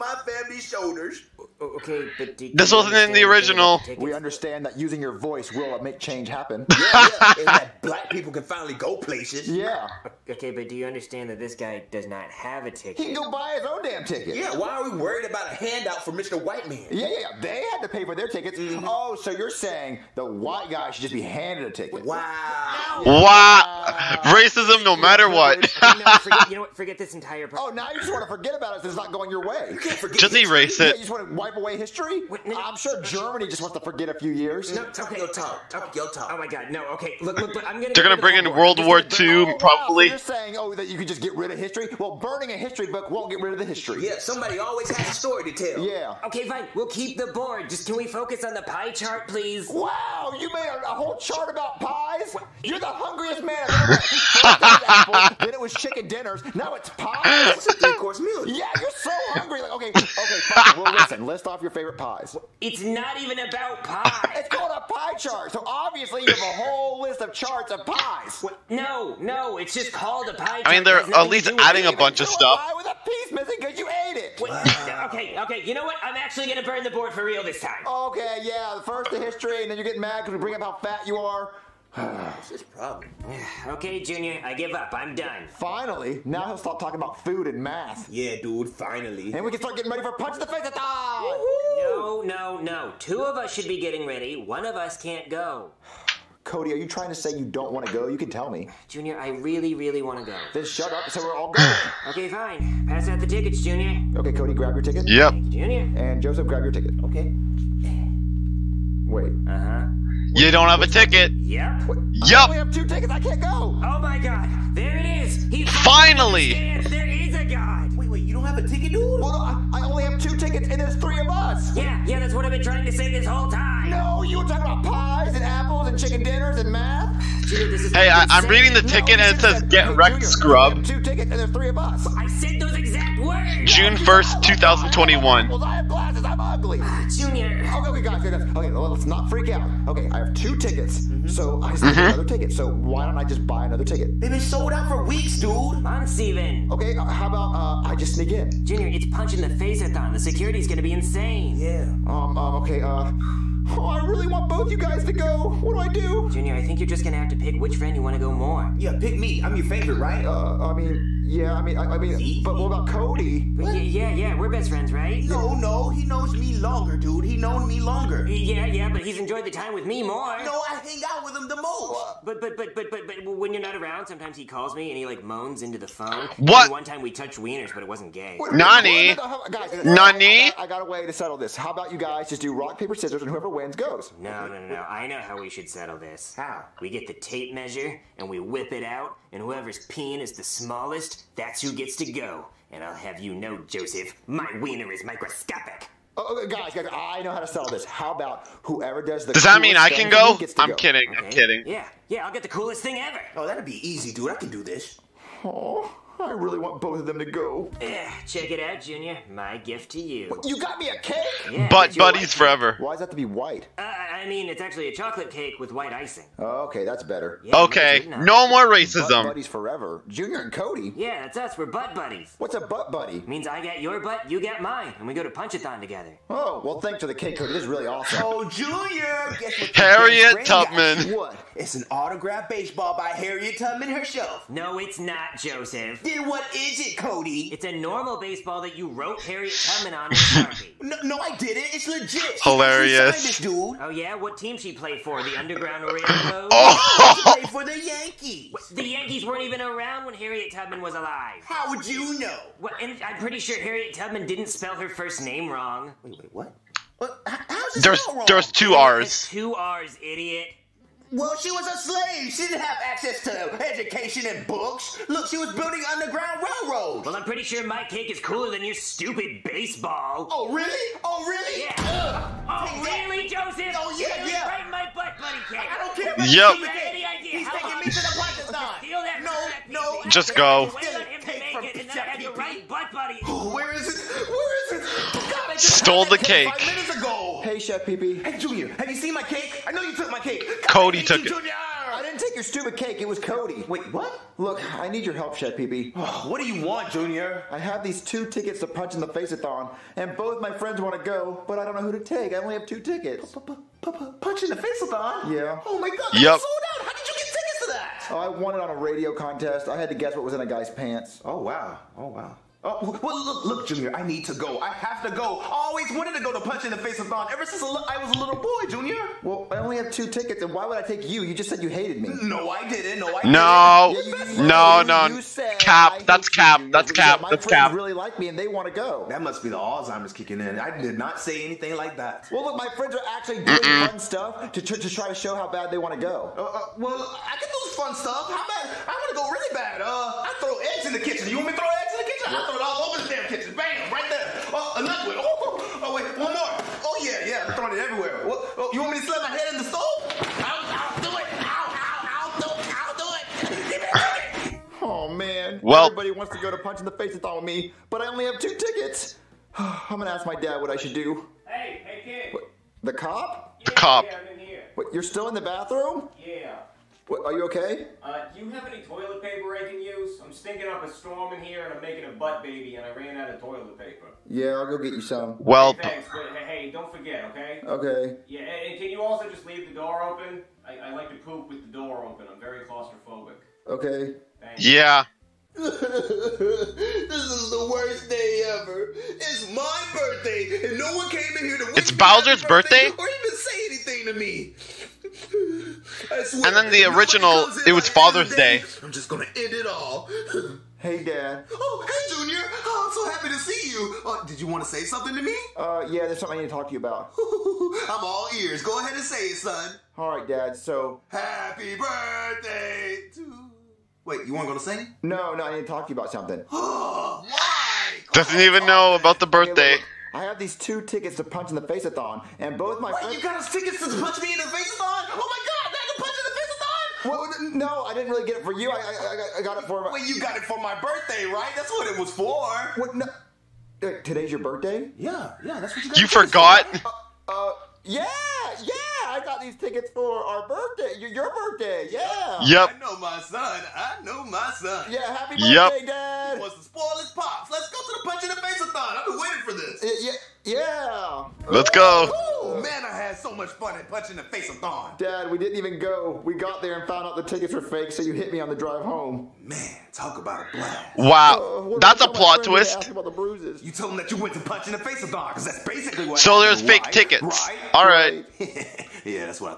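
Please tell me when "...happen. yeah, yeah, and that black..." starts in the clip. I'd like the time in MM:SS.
00:06.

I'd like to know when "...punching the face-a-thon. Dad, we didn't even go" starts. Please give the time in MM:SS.
07:33.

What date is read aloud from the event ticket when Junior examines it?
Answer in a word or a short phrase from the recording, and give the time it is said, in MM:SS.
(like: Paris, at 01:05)
June 1, 2021, at 02:13.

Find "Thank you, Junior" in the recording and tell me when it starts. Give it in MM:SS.
01:45.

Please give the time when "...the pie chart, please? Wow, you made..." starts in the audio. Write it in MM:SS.
00:48.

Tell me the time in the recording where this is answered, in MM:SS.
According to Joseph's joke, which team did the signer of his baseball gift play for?
04:05.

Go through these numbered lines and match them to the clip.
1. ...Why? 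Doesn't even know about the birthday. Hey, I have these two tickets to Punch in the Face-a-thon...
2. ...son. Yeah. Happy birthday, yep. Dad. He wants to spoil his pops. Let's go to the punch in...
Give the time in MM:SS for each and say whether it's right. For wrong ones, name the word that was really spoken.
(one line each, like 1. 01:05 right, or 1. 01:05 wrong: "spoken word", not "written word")
1. 06:56 right
2. 07:24 right.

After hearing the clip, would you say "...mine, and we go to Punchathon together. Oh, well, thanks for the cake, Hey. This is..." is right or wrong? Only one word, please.
wrong.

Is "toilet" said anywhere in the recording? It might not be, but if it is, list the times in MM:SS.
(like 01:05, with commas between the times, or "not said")
06:08, 06:13.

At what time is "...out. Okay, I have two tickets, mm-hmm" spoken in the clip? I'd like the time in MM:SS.
02:19.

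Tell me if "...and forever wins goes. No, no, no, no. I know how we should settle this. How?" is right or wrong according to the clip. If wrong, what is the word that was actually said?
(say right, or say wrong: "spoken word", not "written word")
wrong: "whoever", not "forever".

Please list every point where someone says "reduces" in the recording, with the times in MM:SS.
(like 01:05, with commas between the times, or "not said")
not said.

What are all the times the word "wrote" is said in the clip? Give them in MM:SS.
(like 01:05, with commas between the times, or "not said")
03:58.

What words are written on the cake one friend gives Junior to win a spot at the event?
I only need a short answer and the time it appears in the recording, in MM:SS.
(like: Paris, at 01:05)
Butt buddies forever, at 03:31.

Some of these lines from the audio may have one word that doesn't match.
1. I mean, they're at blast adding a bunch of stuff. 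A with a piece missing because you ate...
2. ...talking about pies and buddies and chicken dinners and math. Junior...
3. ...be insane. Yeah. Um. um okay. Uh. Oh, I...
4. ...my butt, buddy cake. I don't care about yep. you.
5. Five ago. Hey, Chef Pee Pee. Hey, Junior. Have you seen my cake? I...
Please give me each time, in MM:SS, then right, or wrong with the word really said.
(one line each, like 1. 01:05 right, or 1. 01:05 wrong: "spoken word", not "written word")
1. 01:10 wrong: "least", not "blast"
2. 02:04 wrong: "apples", not "buddies"
3. 02:30 right
4. 04:34 right
5. 04:46 right.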